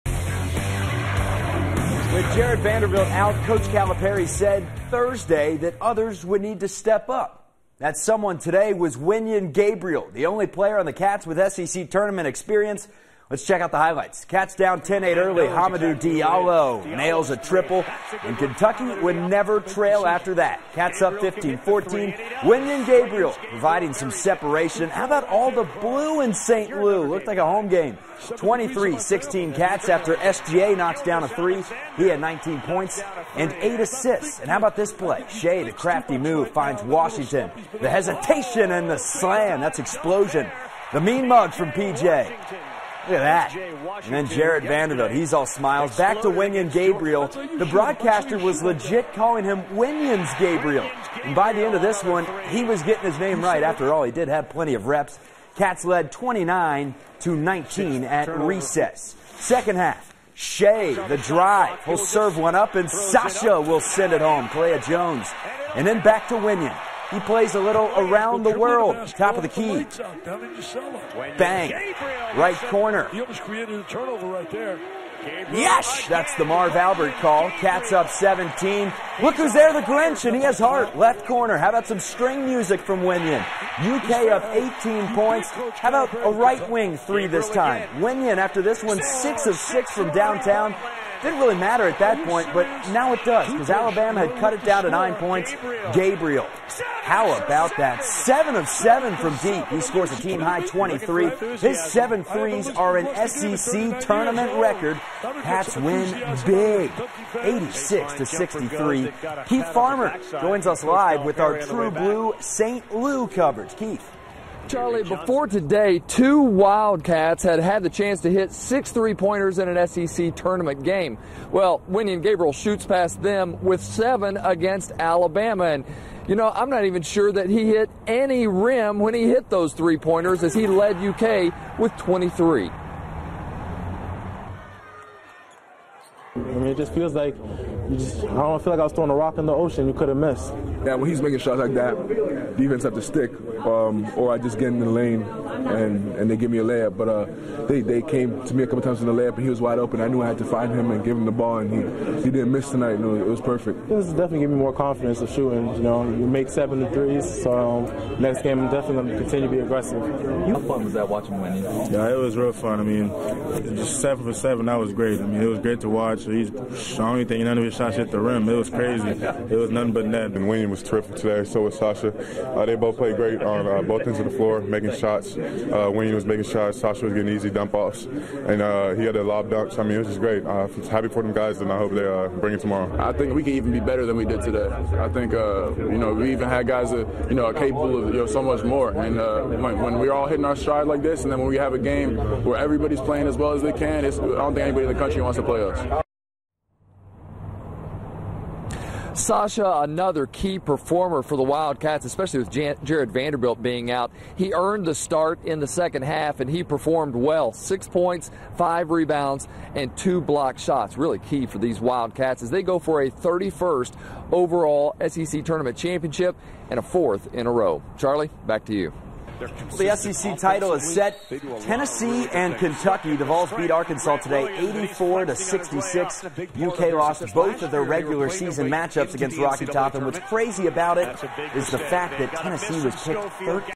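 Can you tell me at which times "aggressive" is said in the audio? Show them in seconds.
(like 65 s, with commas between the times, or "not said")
159 s.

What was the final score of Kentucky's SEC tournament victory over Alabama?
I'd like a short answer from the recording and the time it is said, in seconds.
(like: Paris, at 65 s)
86-63, at 107 s.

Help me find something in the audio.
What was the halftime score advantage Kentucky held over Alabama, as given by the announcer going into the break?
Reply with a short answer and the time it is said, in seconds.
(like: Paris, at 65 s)
29-19, at 56 s.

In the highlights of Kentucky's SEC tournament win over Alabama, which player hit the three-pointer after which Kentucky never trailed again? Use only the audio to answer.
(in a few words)
Hamidou Diallo.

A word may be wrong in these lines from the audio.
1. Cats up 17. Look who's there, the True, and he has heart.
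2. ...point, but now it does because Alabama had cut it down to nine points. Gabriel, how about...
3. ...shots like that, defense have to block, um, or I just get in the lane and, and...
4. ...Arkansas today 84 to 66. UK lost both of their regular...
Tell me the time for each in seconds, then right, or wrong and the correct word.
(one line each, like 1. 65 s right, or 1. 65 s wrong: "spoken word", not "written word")
1. 77 s wrong: "Grinch", not "True"
2. 92 s right
3. 141 s wrong: "stick", not "block"
4. 223 s right.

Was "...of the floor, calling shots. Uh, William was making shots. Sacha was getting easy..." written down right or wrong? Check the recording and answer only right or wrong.
wrong.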